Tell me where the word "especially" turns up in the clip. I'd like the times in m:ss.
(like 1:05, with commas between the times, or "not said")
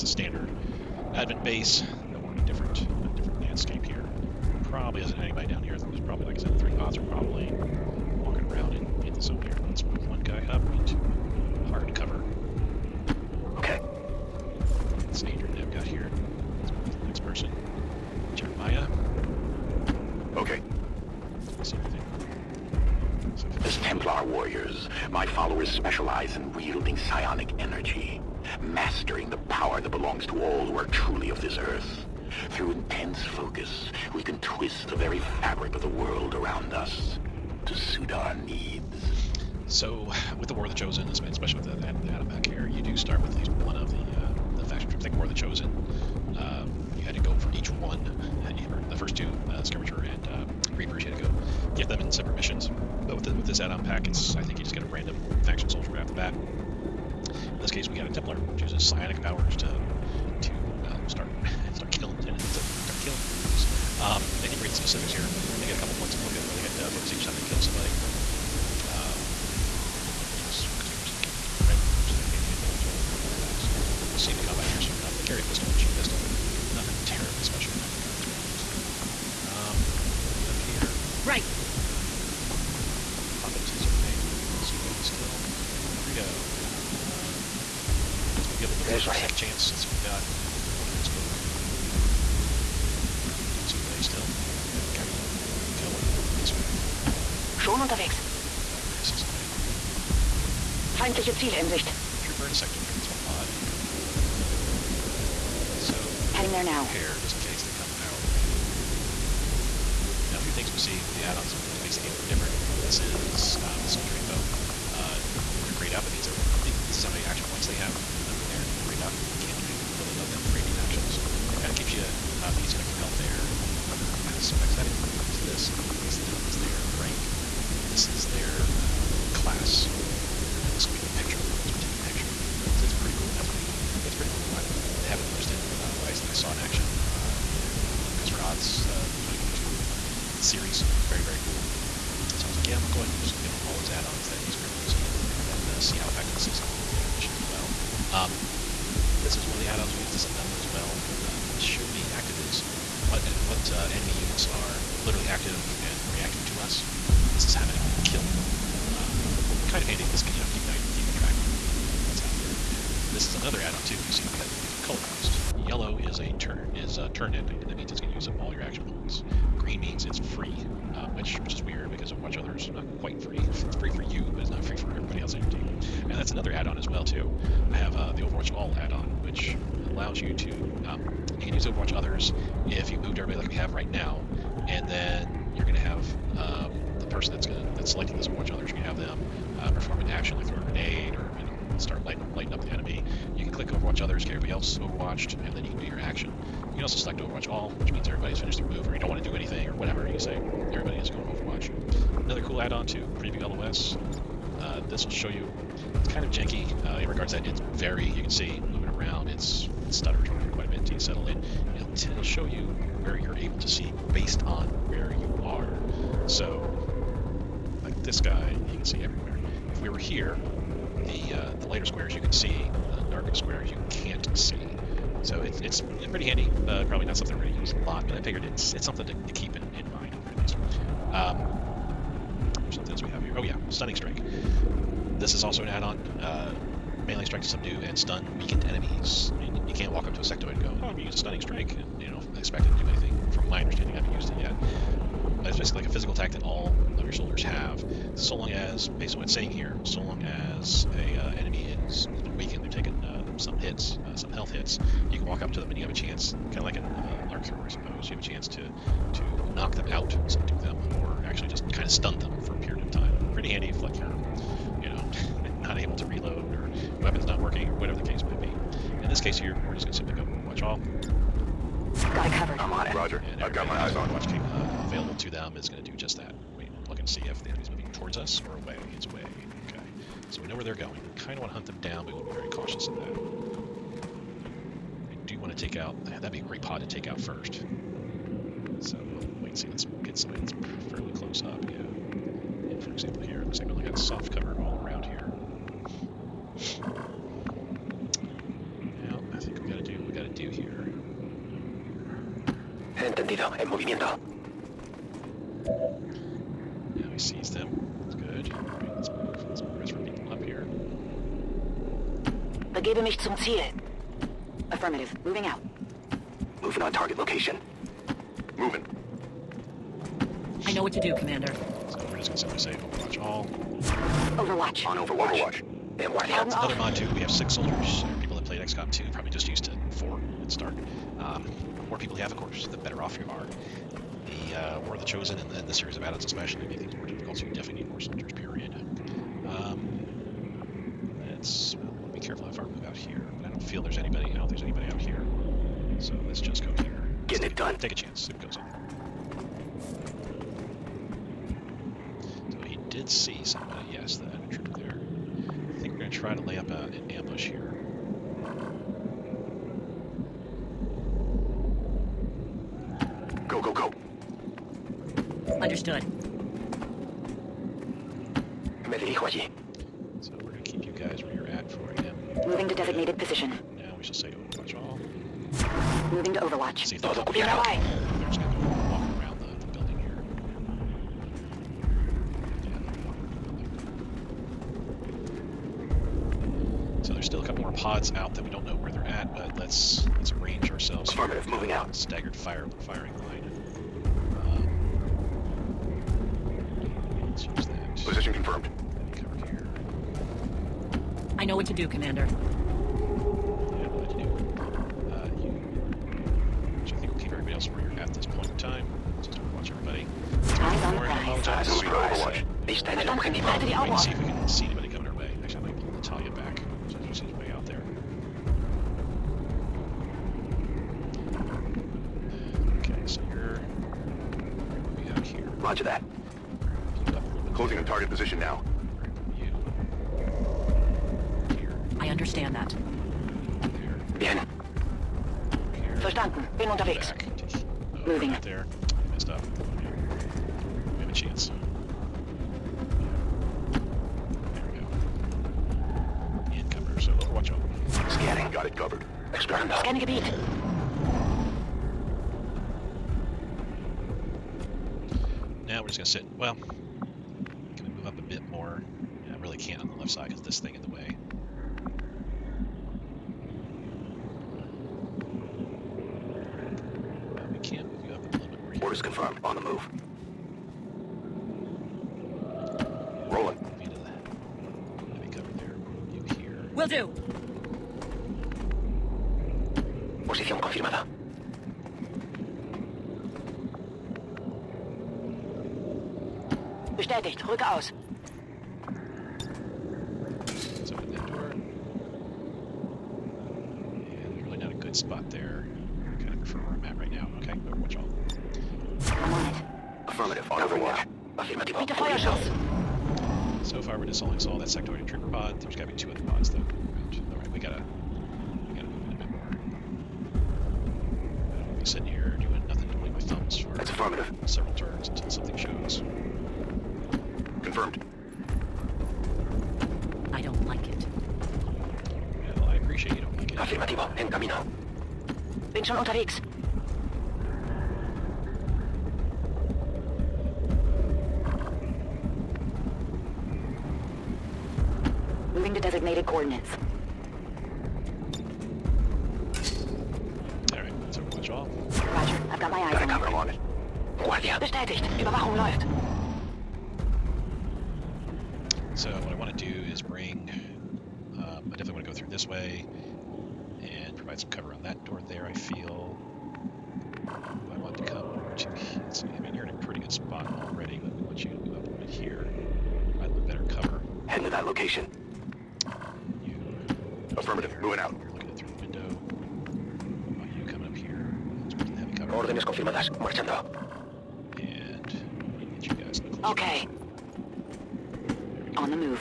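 0:41, 5:36.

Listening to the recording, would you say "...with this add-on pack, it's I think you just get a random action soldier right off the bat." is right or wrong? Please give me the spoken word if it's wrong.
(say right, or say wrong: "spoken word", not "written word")
wrong: "faction", not "action".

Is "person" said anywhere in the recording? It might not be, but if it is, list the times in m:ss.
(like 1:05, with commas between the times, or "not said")
0:17, 3:07.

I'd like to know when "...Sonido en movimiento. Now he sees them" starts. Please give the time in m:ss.
5:03.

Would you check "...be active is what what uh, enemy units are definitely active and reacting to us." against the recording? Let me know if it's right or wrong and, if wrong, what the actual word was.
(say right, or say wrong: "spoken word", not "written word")
wrong: "literally", not "definitely".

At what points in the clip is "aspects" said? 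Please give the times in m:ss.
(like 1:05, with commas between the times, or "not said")
2:04.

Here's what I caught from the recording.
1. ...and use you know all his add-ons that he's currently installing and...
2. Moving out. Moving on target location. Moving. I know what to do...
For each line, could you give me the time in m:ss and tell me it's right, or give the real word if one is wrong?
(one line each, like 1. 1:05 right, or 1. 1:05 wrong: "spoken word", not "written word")
1. 2:23 wrong: "using", not "installing"
2. 5:15 right.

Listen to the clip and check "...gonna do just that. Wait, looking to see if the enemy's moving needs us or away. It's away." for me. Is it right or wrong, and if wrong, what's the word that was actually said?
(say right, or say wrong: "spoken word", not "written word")
wrong: "towards", not "needs".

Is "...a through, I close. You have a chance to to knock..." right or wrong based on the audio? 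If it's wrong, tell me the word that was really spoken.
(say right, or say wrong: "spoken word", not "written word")
wrong: "suppose", not "close".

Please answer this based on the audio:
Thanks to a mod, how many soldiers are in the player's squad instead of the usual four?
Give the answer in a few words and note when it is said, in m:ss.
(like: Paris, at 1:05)
6, at 5:27.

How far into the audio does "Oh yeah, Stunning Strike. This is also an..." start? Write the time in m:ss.
3:53.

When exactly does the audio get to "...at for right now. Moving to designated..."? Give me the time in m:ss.
6:11.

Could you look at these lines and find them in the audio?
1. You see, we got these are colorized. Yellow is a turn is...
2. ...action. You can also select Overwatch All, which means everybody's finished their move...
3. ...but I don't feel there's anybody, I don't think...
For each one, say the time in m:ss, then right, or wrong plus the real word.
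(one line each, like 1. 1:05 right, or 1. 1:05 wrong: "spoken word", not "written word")
1. 2:43 right
2. 3:15 right
3. 5:43 right.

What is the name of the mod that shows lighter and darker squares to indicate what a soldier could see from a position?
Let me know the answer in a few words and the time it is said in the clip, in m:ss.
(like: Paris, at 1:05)
Preview LOS, at 3:23.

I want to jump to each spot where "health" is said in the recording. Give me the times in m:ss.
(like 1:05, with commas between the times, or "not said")
2:02, 4:14.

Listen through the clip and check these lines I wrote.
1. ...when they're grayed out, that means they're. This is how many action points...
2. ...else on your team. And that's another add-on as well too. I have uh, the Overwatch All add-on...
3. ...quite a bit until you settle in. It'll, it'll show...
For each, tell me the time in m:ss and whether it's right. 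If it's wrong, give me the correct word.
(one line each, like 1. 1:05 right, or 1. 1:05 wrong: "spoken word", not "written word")
1. 1:55 right
2. 2:55 right
3. 3:30 right.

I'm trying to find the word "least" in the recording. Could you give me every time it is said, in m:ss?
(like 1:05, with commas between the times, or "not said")
0:43, 2:40, 3:50.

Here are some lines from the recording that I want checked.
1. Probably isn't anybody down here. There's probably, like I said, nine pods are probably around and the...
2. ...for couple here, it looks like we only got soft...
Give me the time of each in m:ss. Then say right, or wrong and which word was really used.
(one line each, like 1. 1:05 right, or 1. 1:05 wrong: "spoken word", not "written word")
1. 0:04 wrong: "three", not "nine"
2. 4:52 wrong: "example", not "couple".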